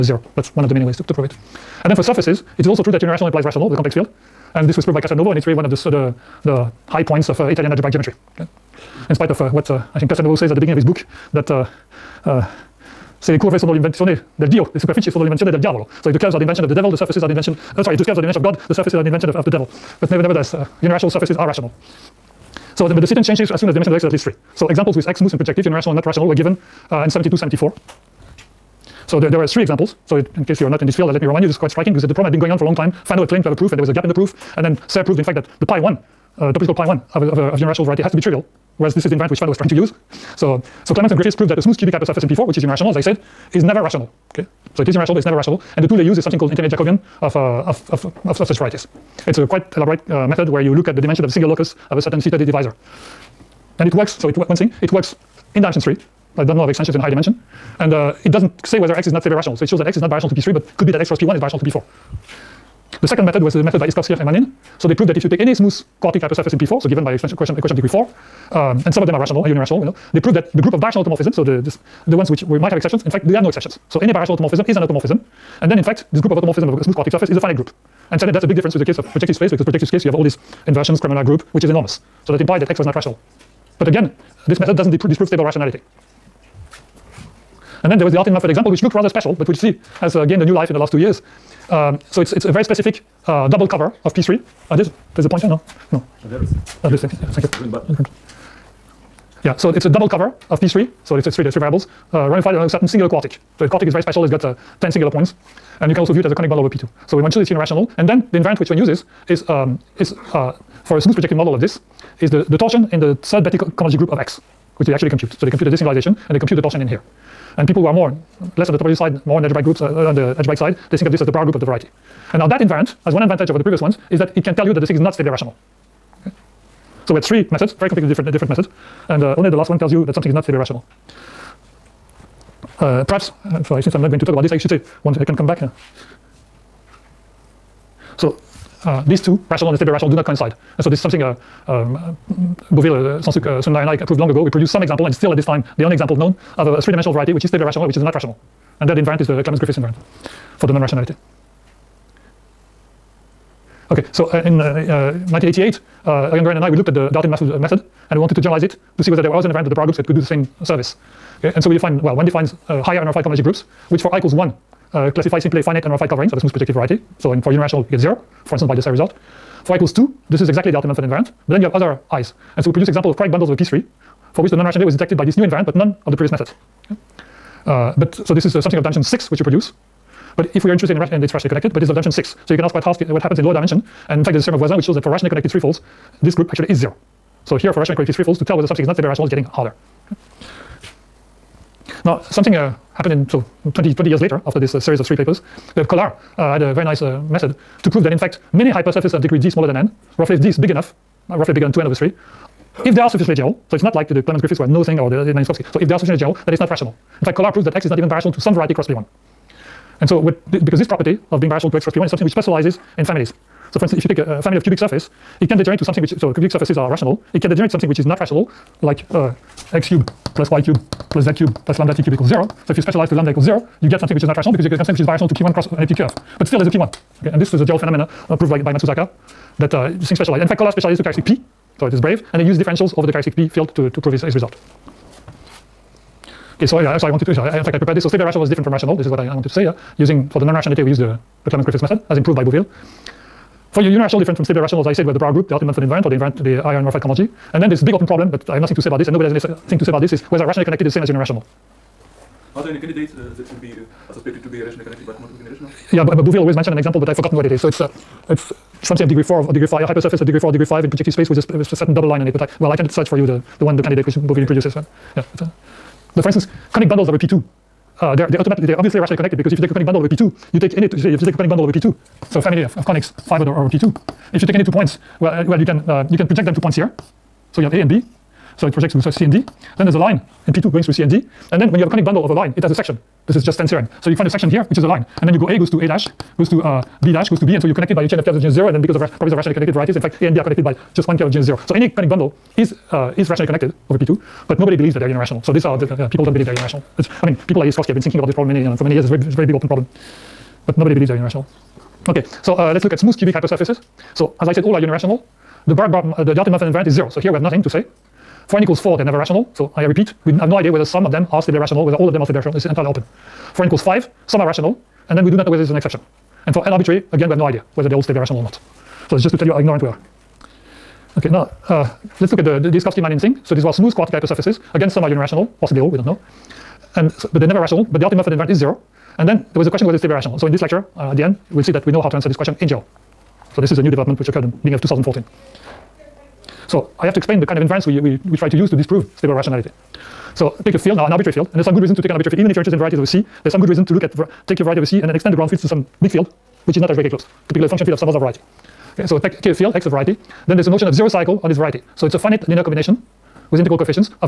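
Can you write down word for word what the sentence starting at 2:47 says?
So in, for unirational, you get 0, for instance, by this result.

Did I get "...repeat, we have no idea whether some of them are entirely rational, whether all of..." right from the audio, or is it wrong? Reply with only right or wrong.
wrong.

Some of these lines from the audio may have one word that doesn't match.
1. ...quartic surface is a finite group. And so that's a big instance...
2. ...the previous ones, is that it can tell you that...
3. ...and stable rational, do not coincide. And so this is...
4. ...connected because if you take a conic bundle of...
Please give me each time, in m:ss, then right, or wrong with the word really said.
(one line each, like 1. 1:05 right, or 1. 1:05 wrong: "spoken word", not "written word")
1. 1:16 wrong: "difference", not "instance"
2. 2:03 right
3. 2:19 right
4. 4:29 right.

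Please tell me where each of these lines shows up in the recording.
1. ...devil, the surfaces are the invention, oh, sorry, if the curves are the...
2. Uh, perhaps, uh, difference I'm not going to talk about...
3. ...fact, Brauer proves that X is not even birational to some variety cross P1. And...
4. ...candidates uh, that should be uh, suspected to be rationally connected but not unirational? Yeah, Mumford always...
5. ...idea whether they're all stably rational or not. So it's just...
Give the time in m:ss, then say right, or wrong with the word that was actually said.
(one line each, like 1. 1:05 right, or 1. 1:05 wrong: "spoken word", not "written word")
1. 0:16 right
2. 2:12 wrong: "since", not "difference"
3. 3:27 wrong: "Kollár", not "Brauer"
4. 4:12 wrong: "Beauville", not "Mumford"
5. 5:17 right.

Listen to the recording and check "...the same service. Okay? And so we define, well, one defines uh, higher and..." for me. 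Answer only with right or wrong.
right.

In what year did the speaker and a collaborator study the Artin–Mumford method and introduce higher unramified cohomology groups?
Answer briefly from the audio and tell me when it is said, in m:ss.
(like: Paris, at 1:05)
1988, at 2:34.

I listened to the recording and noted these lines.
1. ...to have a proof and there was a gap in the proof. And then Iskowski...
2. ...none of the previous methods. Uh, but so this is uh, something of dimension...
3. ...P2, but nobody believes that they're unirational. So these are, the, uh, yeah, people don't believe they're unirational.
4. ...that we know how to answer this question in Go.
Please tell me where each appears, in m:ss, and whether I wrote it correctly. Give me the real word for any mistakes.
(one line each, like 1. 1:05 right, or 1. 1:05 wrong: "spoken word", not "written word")
1. 0:33 wrong: "Serre", not "Iskowski"
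2. 2:55 right
3. 4:53 right
4. 5:31 right.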